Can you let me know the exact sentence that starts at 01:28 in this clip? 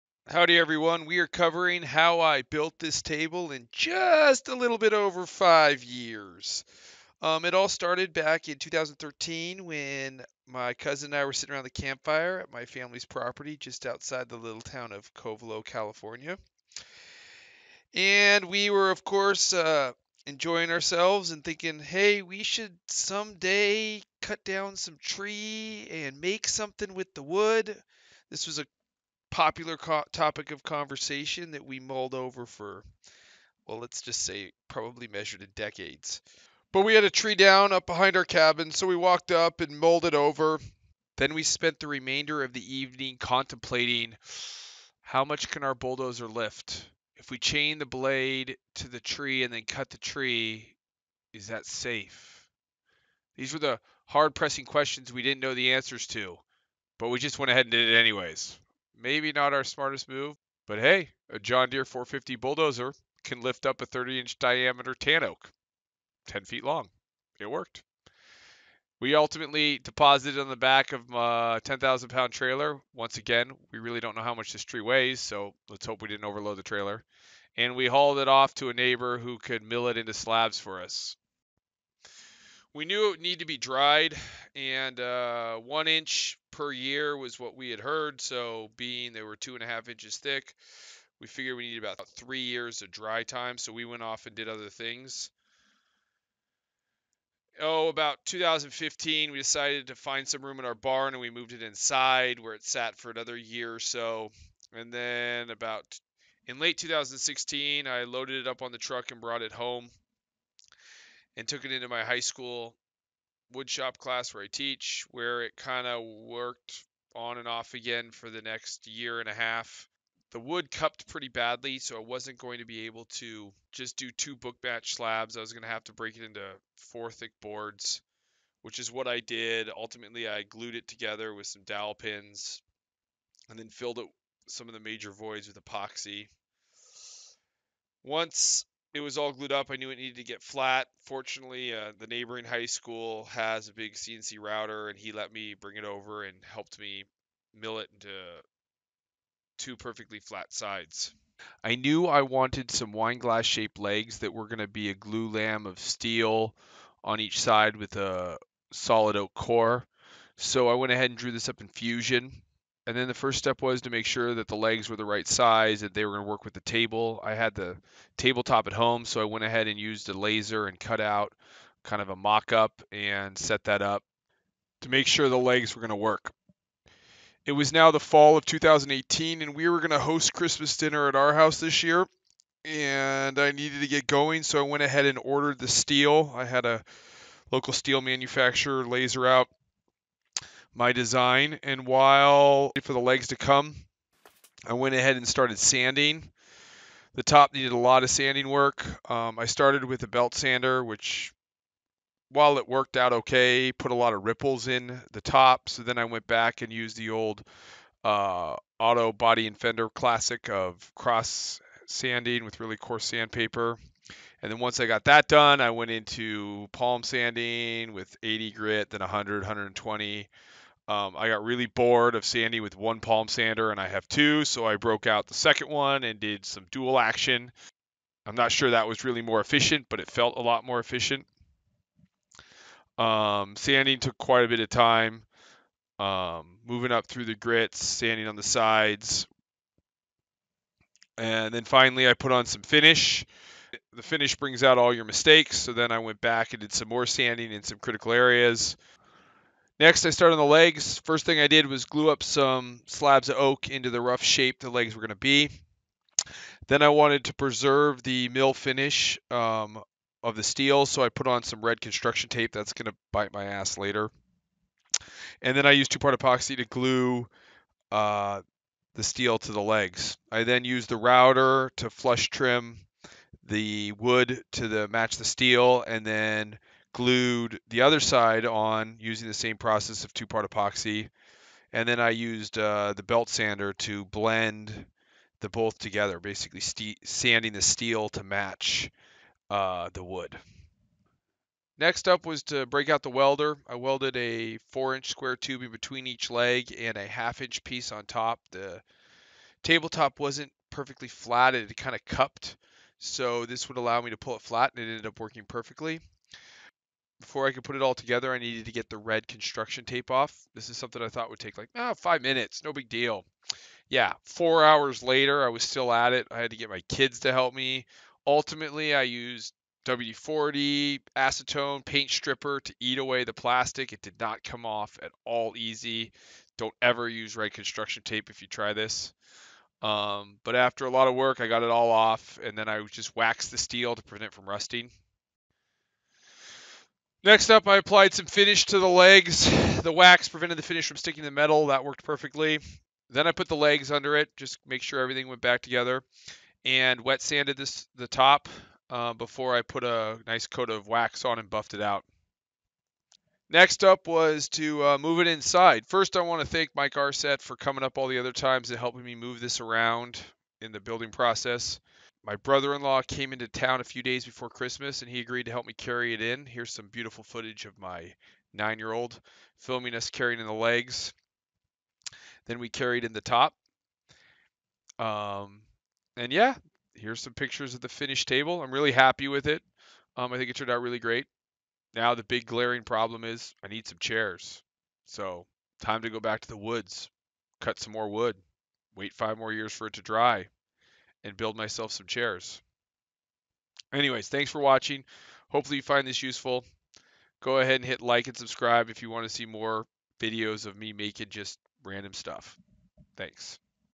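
So, being they were two and a half inches thick, we figured we needed about three years of dry time.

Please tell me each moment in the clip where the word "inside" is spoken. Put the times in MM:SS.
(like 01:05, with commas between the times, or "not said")
01:41, 05:55.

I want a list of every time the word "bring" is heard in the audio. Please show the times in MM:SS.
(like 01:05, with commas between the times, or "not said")
02:25, 04:04.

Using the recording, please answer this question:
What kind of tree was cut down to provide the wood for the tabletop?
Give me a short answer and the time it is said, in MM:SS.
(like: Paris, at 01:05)
tan oak, at 01:04.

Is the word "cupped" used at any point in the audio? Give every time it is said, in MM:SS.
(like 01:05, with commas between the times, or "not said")
02:00, 05:02.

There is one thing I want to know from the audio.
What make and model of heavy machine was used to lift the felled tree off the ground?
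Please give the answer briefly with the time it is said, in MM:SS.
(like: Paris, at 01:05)
John Deere 450, at 01:01.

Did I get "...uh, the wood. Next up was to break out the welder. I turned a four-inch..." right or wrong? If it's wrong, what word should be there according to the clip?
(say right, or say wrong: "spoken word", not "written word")
wrong: "welded", not "turned".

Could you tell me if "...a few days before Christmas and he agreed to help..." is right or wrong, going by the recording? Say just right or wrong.
right.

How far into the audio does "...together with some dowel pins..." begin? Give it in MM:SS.
02:10.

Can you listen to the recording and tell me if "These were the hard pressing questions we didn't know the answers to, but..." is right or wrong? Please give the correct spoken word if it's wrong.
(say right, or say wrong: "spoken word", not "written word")
right.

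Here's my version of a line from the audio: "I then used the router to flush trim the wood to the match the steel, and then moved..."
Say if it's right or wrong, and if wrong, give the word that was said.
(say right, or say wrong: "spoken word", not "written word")
wrong: "glued", not "moved".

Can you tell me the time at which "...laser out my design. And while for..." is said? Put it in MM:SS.
03:08.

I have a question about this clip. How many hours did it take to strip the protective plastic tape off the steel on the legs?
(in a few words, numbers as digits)
4.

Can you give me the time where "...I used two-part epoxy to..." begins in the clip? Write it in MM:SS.
04:25.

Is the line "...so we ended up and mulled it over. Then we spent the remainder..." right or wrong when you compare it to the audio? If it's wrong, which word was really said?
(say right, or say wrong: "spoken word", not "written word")
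wrong: "walked", not "ended".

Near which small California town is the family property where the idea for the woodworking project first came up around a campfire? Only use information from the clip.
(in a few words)
Covelo.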